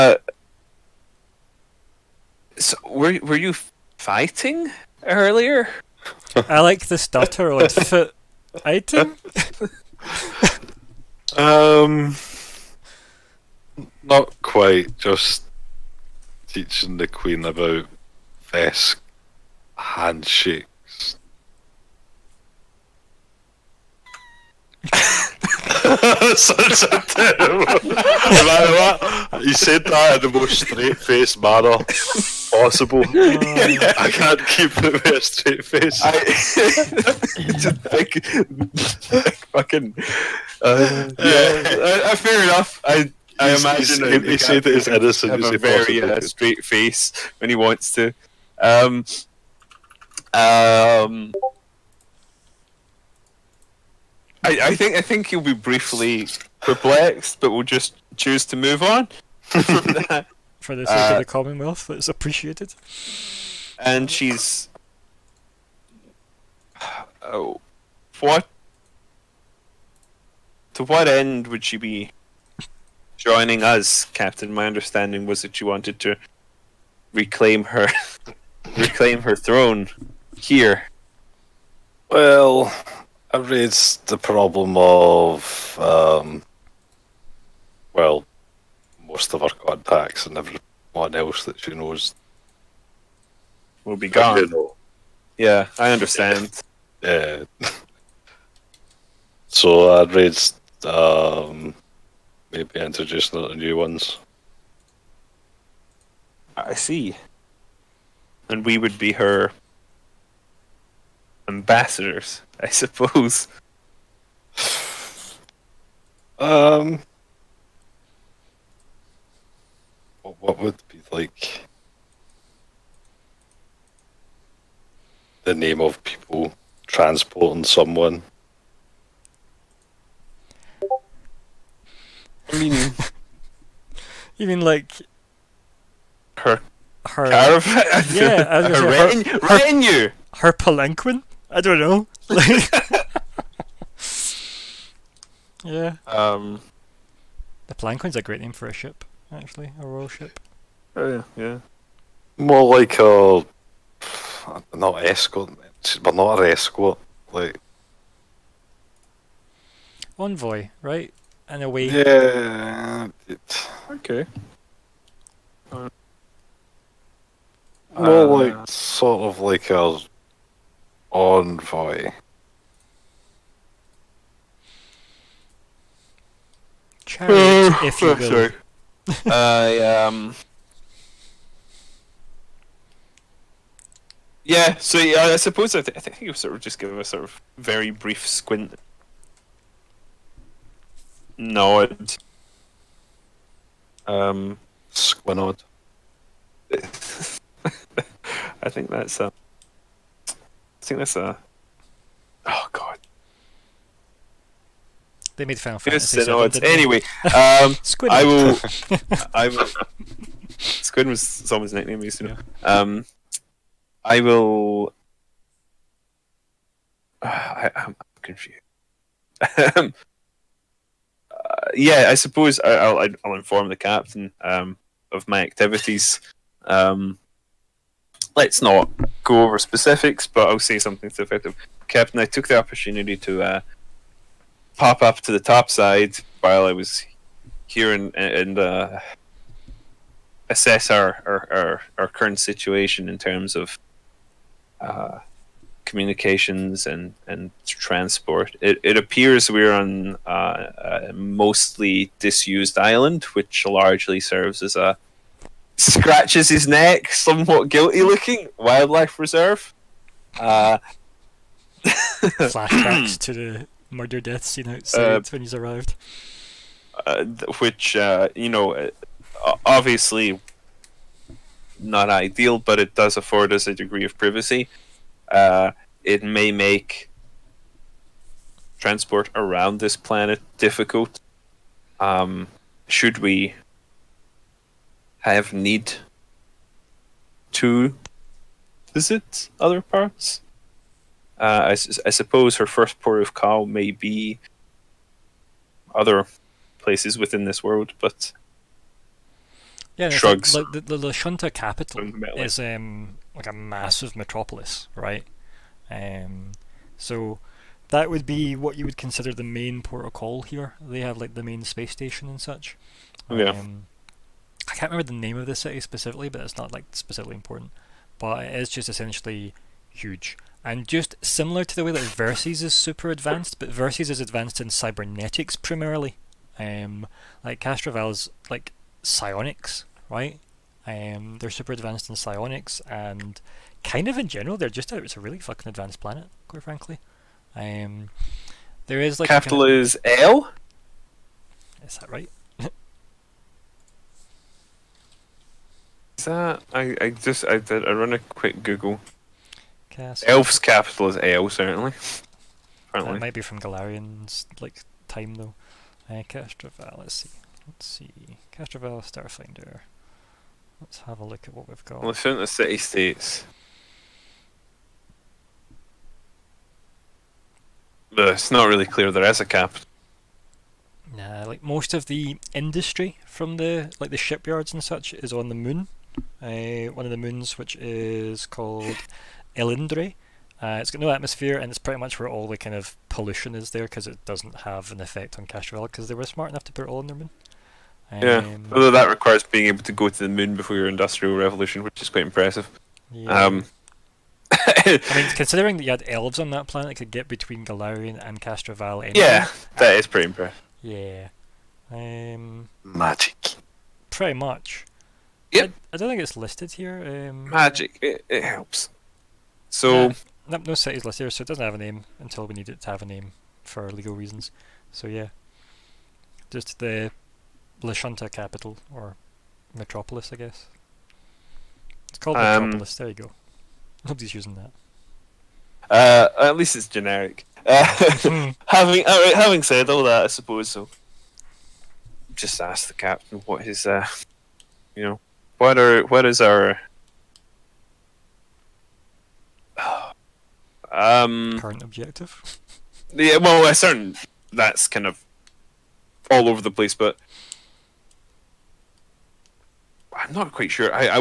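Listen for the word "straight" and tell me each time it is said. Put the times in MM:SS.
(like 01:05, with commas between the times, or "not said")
00:30, 00:35, 00:46.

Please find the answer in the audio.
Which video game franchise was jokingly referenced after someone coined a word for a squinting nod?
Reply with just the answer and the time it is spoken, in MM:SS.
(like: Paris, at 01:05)
Final Fantasy, at 03:25.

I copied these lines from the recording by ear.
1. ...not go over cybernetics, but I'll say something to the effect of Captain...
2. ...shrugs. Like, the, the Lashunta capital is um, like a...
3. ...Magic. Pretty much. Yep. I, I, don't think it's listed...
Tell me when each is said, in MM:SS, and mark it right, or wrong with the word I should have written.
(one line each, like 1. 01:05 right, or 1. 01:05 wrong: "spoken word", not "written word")
1. 03:48 wrong: "specifics", not "cybernetics"
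2. 05:00 right
3. 06:42 right.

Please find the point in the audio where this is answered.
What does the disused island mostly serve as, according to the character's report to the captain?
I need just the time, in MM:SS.
04:18.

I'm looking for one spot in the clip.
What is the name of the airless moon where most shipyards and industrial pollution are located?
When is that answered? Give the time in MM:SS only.
06:19.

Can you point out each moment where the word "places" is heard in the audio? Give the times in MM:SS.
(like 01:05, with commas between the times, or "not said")
04:56, 07:26.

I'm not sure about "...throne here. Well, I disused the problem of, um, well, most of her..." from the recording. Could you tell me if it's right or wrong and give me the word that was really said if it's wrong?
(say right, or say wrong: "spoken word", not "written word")
wrong: "raised", not "disused".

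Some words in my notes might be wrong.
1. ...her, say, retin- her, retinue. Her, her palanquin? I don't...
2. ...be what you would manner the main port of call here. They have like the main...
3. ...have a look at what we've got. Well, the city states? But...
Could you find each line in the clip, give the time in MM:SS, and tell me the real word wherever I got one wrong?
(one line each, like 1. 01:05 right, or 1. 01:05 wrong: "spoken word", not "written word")
1. 02:18 right
2. 05:08 wrong: "consider", not "manner"
3. 06:01 right.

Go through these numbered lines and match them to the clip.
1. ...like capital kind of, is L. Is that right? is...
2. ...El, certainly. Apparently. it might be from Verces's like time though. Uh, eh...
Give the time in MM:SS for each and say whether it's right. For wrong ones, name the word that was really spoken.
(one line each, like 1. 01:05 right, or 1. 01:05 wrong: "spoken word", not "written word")
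1. 05:39 right
2. 05:51 wrong: "Golarion", not "Verces".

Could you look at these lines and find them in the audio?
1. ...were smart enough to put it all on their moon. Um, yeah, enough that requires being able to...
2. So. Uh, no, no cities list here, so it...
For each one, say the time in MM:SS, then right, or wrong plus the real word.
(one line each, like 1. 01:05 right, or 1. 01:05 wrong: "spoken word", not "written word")
1. 06:26 wrong: "although", not "enough"
2. 06:49 right.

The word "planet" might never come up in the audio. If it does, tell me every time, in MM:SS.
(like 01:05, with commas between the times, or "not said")
04:39, 05:36, 06:36.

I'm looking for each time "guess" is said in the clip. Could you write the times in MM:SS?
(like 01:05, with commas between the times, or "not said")
07:00.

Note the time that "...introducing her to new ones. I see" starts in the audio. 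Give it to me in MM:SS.
01:42.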